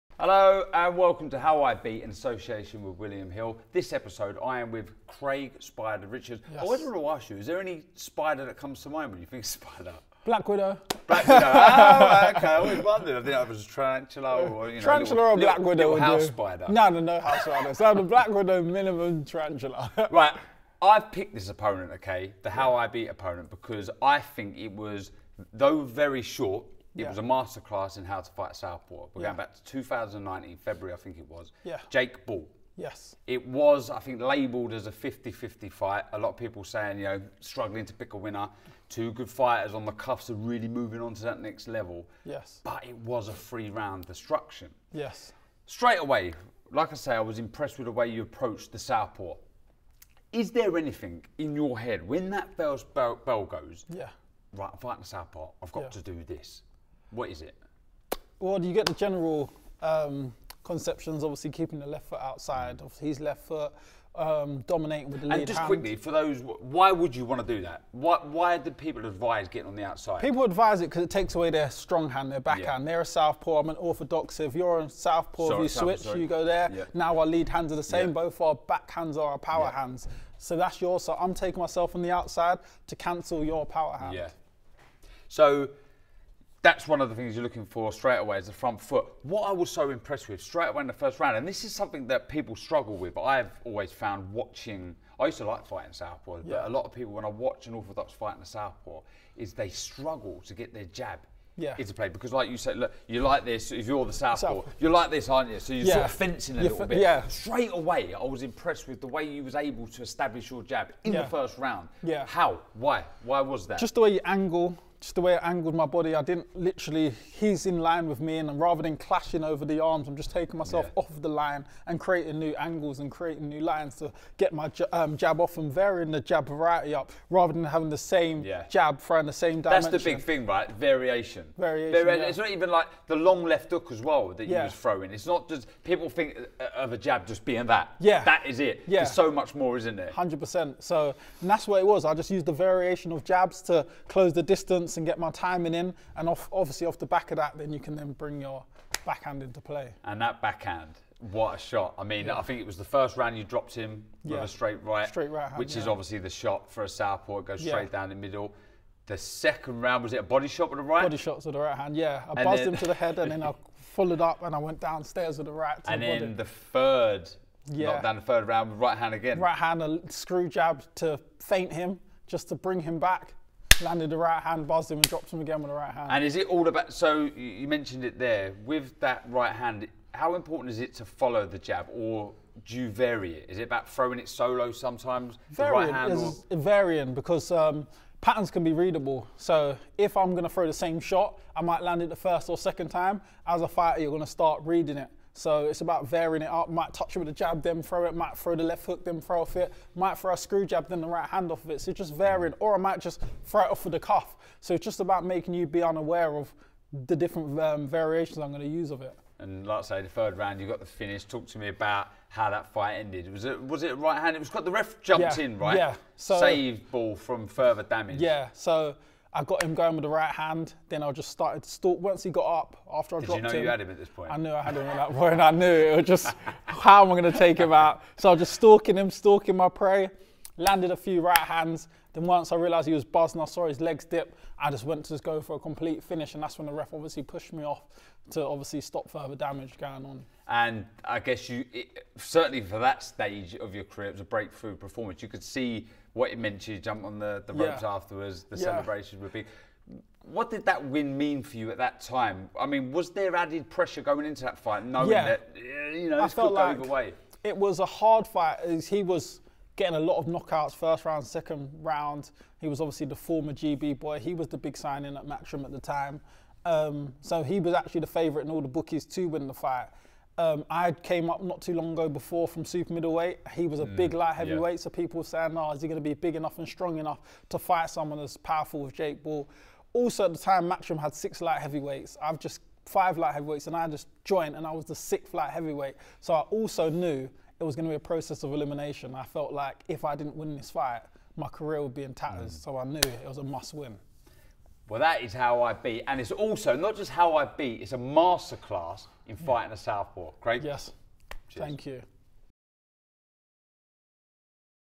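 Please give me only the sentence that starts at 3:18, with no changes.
Might throw the left hook, then throw off it.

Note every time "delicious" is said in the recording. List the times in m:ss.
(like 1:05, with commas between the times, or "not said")
not said.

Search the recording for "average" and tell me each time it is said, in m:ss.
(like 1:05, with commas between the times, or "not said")
not said.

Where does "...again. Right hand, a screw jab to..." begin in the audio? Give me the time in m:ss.
2:49.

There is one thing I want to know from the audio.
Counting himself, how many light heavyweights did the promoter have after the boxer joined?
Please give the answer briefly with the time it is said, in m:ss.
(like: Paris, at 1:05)
6, at 4:44.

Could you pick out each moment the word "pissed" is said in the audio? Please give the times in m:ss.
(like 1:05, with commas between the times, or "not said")
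not said.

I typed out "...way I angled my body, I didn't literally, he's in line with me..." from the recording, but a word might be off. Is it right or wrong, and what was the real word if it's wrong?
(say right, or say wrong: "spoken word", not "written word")
right.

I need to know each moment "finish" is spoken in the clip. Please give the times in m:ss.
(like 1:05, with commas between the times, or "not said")
3:30, 3:56.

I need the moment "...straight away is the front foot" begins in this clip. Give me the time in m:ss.
1:27.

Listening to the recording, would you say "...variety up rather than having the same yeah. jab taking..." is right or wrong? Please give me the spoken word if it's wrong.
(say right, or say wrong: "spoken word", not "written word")
wrong: "throwing", not "taking".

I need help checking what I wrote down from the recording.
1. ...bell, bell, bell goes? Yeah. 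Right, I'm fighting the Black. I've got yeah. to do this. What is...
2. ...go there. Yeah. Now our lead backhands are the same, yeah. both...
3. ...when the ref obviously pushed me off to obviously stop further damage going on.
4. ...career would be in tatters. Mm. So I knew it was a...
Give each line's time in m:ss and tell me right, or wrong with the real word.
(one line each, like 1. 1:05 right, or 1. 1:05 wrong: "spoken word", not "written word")
1. 0:52 wrong: "Southpaw", not "Black"
2. 1:16 wrong: "hands", not "backhands"
3. 3:56 right
4. 4:51 right.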